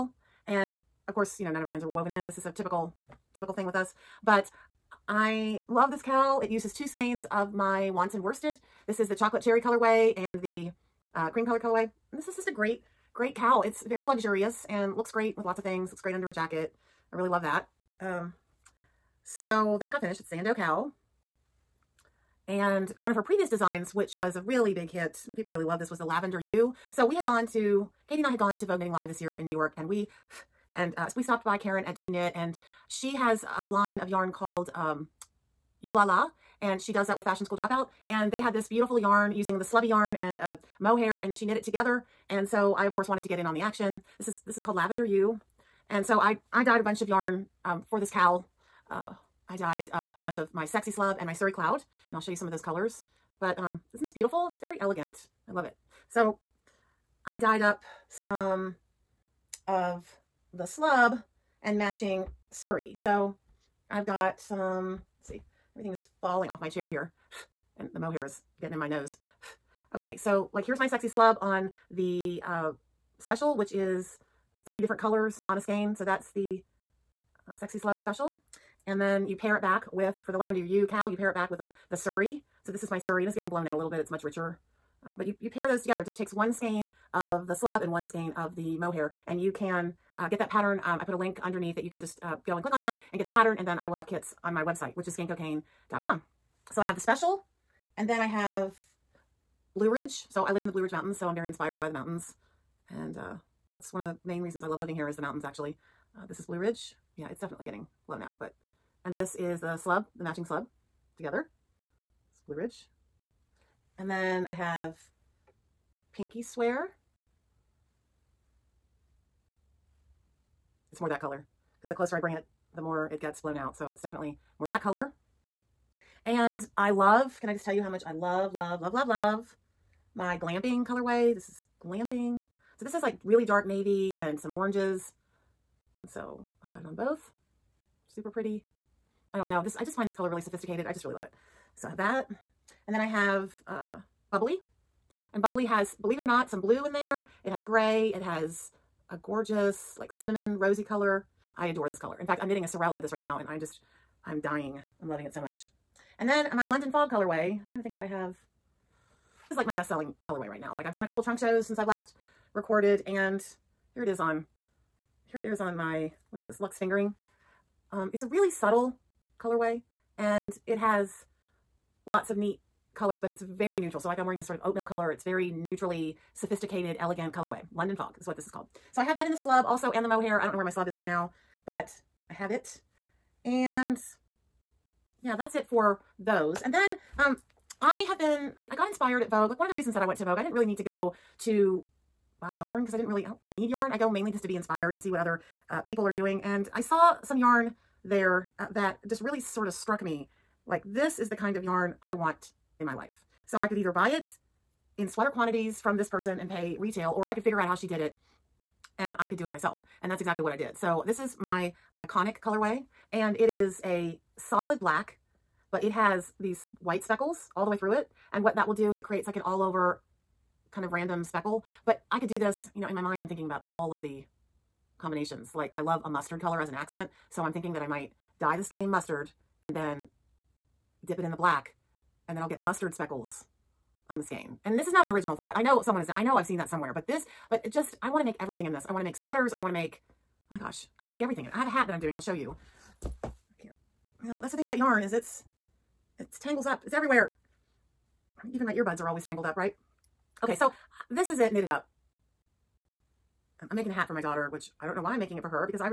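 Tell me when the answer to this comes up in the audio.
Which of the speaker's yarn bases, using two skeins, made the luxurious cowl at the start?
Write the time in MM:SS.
00:07.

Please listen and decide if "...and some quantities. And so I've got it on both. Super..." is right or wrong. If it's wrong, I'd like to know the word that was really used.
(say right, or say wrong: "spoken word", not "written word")
wrong: "oranges", not "quantities".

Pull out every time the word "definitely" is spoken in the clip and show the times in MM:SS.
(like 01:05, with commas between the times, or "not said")
01:47, 02:04.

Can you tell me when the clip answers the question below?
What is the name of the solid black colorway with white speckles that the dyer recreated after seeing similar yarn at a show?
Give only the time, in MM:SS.
03:31.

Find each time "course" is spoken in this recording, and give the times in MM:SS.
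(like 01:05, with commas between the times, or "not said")
00:01, 00:42.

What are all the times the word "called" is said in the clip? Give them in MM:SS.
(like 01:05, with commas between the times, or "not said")
00:34, 00:44, 02:58.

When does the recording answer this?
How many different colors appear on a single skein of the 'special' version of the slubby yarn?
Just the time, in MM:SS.
01:14.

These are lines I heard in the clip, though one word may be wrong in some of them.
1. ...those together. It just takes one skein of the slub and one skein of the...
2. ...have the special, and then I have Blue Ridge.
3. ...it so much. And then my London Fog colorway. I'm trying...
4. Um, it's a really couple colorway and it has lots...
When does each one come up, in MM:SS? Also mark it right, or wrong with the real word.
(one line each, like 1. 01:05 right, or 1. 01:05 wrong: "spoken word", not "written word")
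1. 01:25 right
2. 01:36 right
3. 02:35 right
4. 02:47 wrong: "subtle", not "couple".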